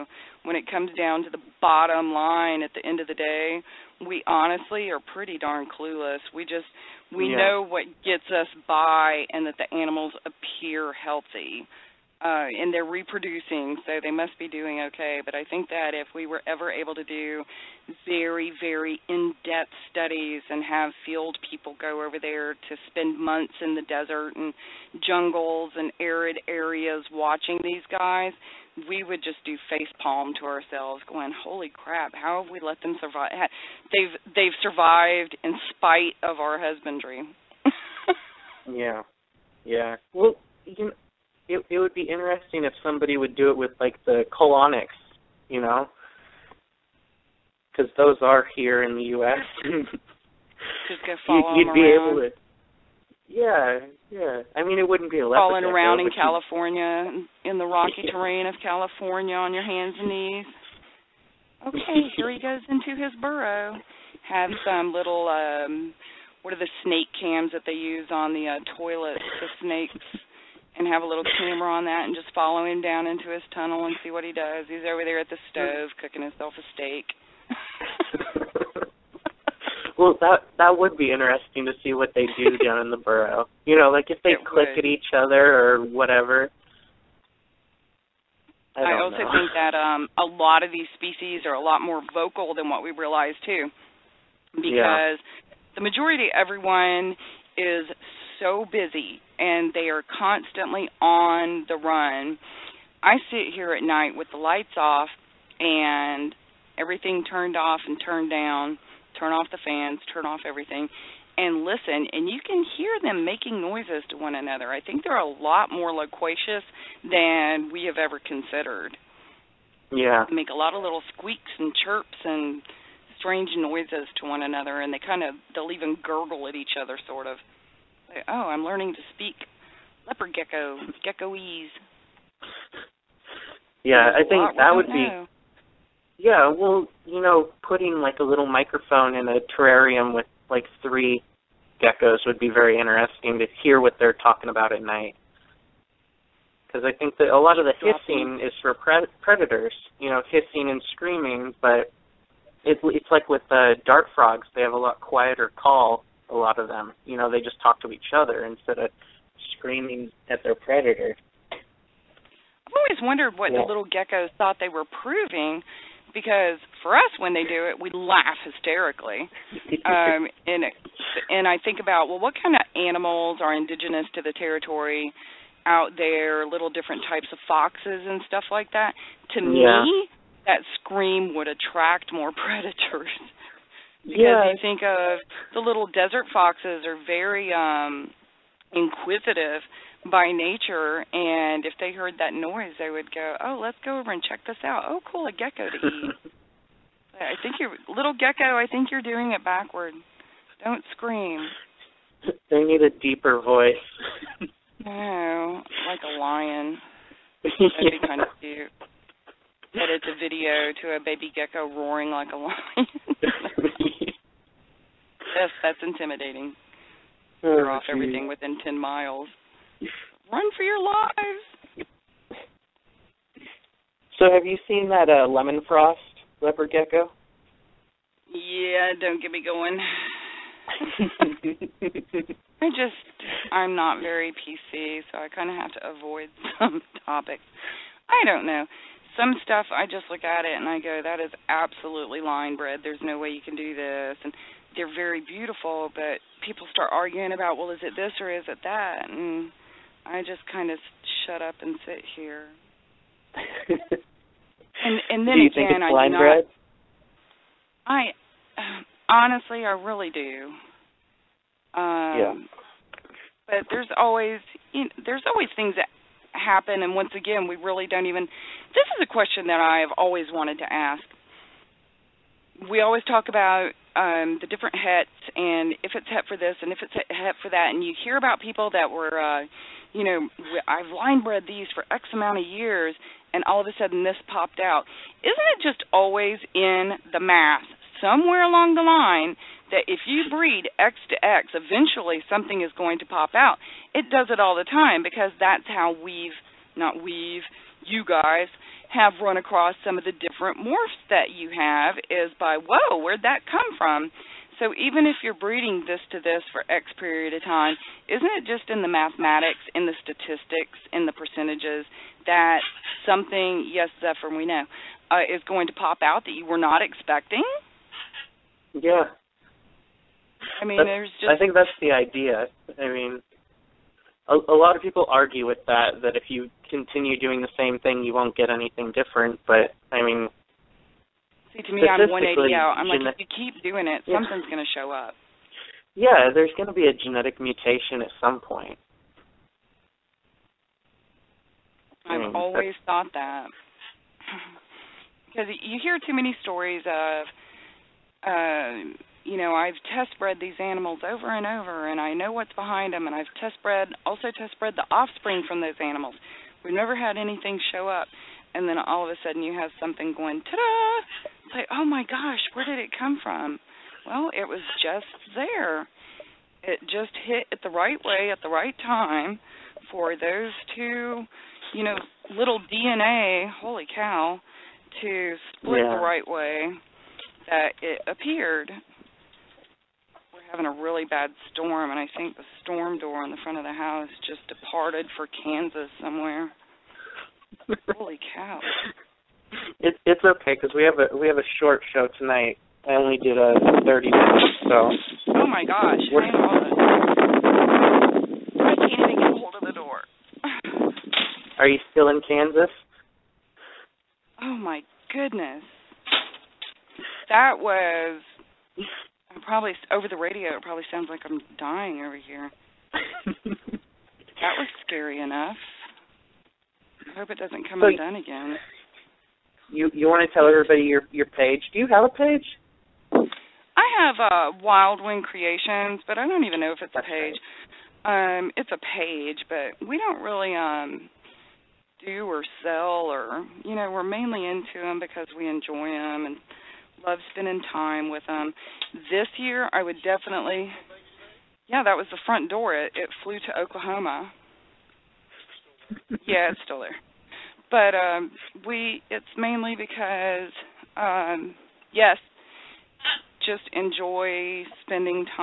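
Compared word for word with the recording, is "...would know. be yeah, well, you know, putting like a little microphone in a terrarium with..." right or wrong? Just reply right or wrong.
right.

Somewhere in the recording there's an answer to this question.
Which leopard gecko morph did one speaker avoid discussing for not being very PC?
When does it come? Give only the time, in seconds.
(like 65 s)
225 s.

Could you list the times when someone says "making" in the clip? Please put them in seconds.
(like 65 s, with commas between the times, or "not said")
113 s.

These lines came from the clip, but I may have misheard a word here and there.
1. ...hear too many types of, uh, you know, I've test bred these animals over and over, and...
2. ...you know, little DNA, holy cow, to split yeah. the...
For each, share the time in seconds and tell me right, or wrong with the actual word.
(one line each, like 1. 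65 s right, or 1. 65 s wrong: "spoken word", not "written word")
1. 345 s wrong: "stories", not "types"
2. 371 s right.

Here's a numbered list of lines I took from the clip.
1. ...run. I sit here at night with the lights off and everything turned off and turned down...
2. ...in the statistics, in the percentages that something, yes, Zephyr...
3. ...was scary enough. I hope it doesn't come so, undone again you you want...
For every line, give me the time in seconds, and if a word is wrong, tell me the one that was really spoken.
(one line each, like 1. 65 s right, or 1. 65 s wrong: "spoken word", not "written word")
1. 101 s right
2. 309 s right
3. 414 s right.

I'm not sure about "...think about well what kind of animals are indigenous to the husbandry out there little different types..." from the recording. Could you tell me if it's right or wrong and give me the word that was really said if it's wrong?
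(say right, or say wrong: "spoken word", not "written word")
wrong: "territory", not "husbandry".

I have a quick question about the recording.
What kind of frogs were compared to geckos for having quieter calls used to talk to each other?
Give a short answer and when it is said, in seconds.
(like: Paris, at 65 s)
Dart frogs, at 153 s.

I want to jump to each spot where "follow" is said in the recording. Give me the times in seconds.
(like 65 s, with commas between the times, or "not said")
51 s, 72 s.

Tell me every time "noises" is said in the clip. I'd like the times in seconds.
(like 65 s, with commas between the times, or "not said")
113 s, 123 s, 192 s.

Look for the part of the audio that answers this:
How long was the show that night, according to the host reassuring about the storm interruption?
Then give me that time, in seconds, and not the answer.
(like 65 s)
393 s.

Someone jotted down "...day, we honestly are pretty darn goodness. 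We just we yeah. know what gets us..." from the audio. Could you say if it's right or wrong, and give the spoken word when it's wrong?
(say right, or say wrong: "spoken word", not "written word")
wrong: "clueless", not "goodness".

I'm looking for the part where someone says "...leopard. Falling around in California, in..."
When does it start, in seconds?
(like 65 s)
55 s.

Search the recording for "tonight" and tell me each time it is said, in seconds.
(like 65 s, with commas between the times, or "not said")
392 s.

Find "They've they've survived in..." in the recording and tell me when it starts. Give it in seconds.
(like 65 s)
33 s.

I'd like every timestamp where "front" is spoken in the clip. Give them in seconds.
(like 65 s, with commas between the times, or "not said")
383 s, 442 s.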